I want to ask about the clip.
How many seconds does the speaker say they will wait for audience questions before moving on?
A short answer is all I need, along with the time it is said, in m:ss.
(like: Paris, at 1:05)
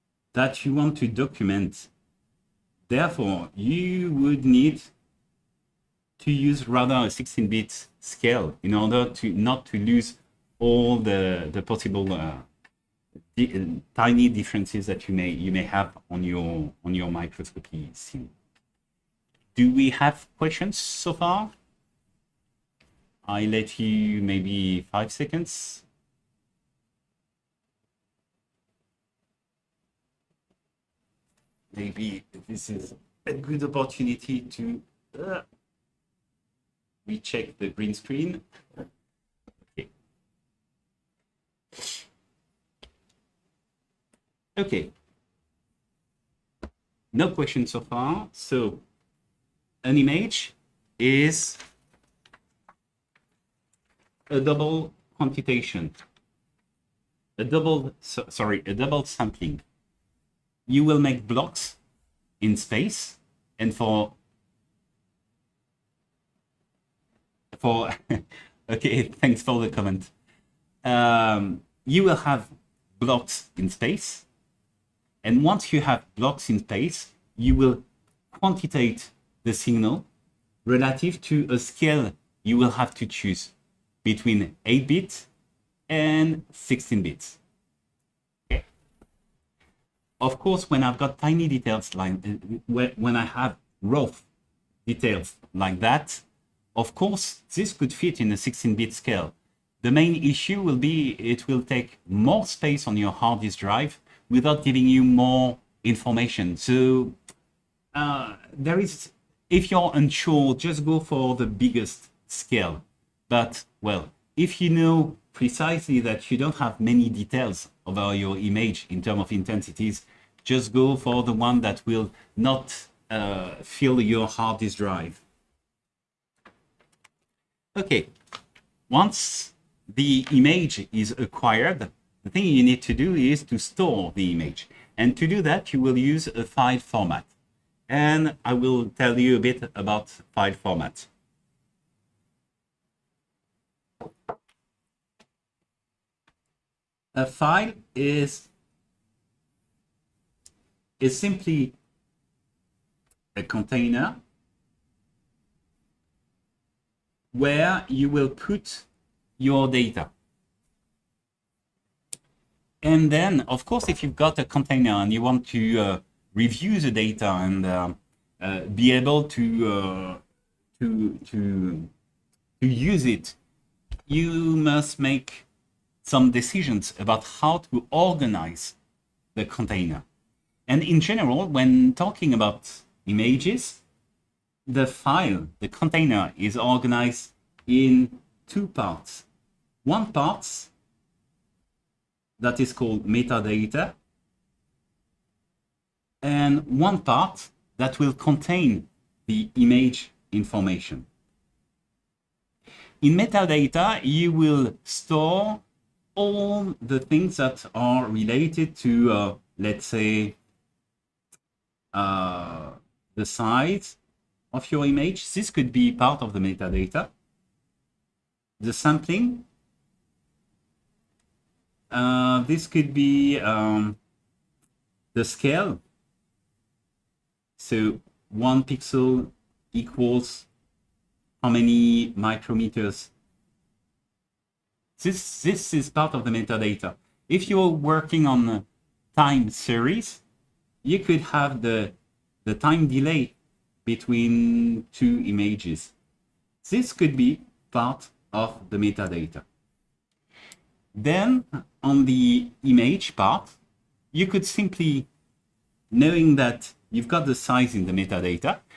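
5, at 0:24.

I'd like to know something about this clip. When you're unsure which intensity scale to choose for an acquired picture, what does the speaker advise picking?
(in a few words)
the biggest scale.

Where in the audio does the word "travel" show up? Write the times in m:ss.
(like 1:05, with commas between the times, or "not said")
not said.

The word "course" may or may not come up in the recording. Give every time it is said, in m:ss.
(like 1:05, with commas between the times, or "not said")
1:30, 1:36, 2:43.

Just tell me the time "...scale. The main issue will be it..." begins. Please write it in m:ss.
1:38.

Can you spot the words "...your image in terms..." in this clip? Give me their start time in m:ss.
1:58.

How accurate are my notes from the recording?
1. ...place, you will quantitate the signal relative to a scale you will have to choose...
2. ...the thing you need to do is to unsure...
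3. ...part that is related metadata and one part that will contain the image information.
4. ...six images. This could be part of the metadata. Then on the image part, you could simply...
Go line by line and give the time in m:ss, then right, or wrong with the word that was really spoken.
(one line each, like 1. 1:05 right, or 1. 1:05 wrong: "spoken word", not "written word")
1. 1:16 right
2. 2:12 wrong: "store", not "unsure"
3. 3:10 wrong: "called", not "related"
4. 4:04 wrong: "two", not "six".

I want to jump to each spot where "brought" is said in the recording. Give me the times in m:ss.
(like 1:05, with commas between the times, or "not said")
not said.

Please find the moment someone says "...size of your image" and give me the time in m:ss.
3:33.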